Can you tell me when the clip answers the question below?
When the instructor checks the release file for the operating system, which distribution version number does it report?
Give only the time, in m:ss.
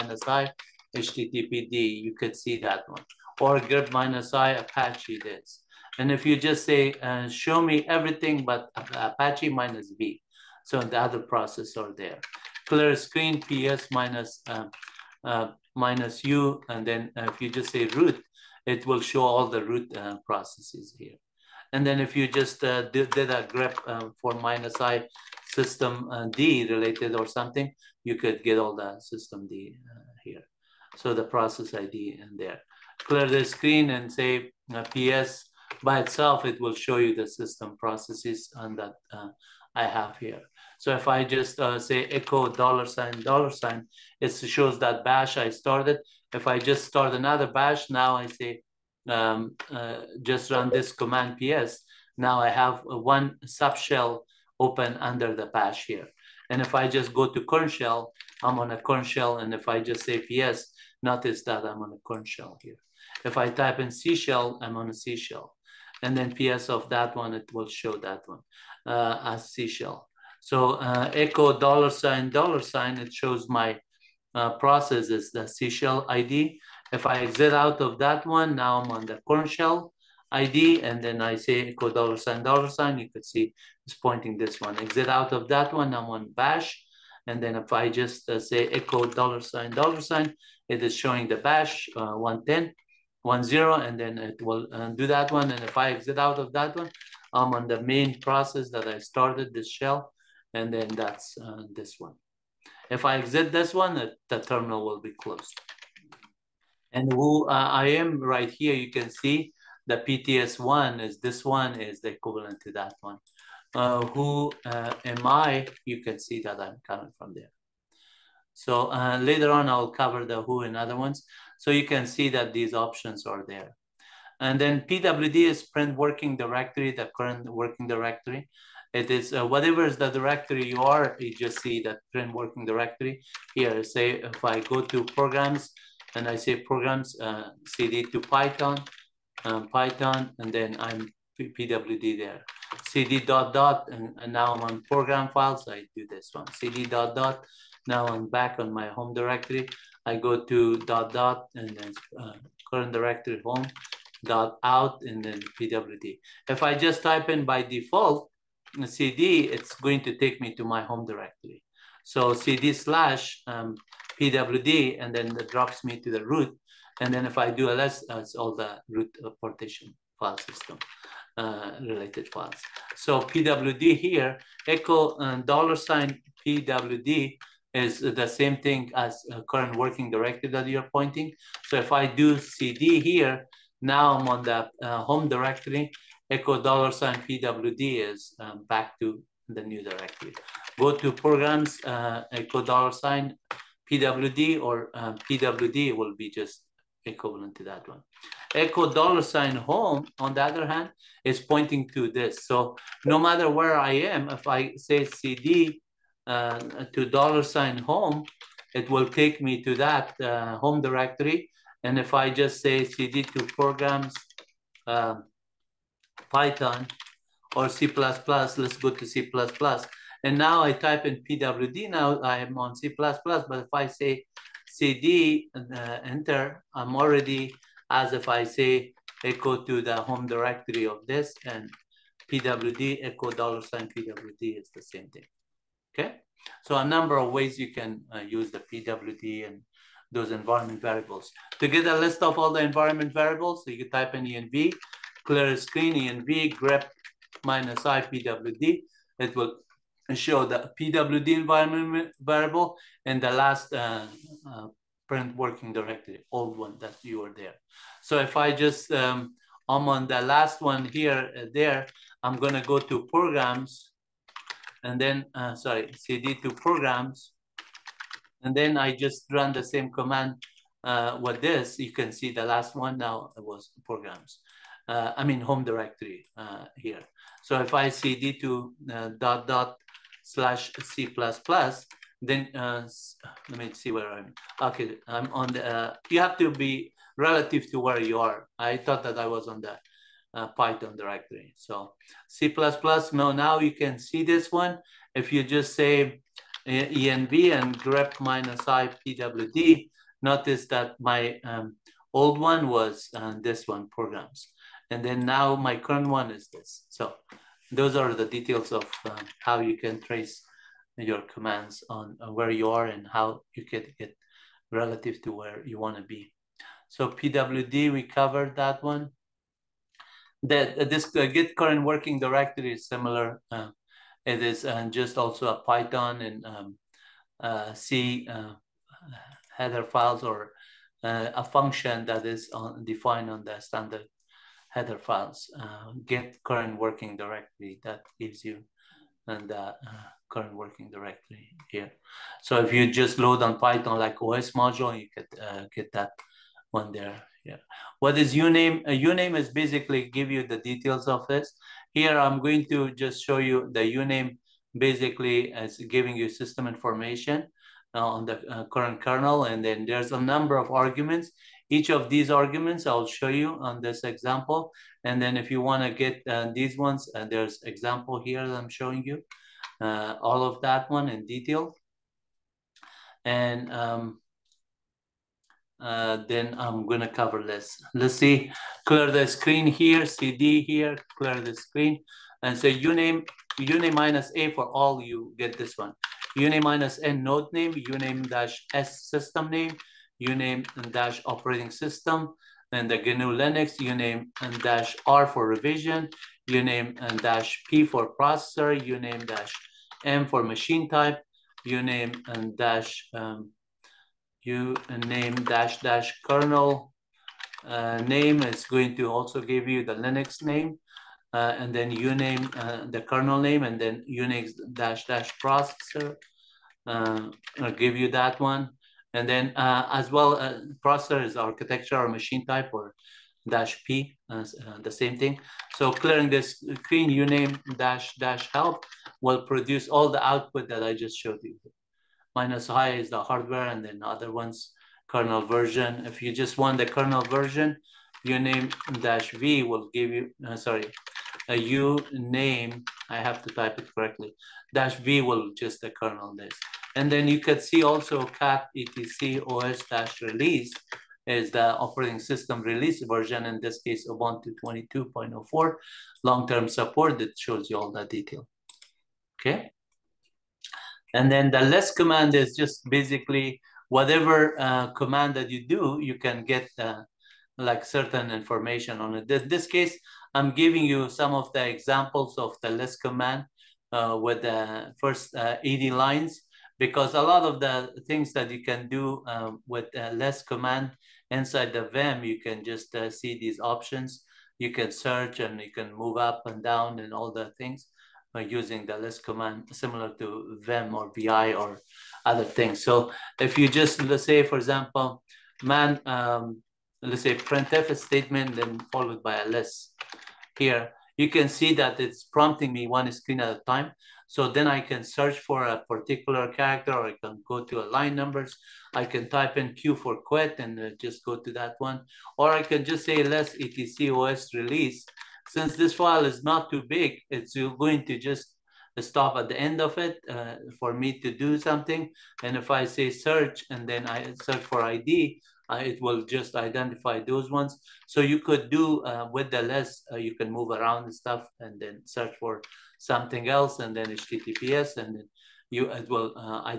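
7:34.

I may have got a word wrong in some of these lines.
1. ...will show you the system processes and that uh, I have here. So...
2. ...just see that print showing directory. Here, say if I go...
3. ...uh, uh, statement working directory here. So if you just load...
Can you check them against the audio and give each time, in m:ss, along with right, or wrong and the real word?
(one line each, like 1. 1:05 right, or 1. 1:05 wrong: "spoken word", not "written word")
1. 0:36 right
2. 2:11 wrong: "working", not "showing"
3. 5:39 wrong: "current", not "statement".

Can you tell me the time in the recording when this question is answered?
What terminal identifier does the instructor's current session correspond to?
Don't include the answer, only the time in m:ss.
1:49.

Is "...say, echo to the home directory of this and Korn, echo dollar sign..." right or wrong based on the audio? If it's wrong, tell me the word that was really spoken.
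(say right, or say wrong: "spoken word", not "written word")
wrong: "PWD", not "Korn".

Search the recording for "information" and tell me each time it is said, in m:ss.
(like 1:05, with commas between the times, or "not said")
5:56, 7:48.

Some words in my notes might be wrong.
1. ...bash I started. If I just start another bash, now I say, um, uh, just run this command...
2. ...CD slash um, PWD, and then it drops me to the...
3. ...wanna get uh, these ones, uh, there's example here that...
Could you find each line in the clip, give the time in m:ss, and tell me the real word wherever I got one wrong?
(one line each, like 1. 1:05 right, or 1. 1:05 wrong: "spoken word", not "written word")
1. 0:45 right
2. 2:42 right
3. 6:05 right.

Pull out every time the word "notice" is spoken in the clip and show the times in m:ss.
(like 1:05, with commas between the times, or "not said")
1:01, 5:00.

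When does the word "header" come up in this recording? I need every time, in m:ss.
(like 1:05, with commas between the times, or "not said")
5:29, 5:34.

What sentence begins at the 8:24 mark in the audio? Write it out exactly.
So then I can search for a particular character or I can go to a line numbers.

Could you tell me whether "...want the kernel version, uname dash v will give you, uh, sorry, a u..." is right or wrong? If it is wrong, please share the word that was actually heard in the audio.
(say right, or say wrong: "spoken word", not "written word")
right.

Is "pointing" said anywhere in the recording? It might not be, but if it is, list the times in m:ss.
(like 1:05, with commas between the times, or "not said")
1:23, 3:00, 3:21.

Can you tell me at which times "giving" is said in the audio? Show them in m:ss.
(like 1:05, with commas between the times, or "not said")
5:55, 7:50.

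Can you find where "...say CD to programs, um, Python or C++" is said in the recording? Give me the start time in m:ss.
3:32.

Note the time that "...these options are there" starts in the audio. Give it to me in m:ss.
2:02.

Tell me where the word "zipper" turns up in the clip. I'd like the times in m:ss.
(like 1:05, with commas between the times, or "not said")
not said.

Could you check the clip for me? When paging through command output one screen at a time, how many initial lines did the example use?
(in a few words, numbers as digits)
80.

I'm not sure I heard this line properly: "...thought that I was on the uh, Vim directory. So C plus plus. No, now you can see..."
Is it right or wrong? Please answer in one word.
wrong.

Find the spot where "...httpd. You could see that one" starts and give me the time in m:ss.
0:00.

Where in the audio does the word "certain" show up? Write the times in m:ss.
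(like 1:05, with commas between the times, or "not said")
7:47.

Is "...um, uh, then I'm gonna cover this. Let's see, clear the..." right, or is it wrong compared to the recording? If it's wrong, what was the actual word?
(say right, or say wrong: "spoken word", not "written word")
right.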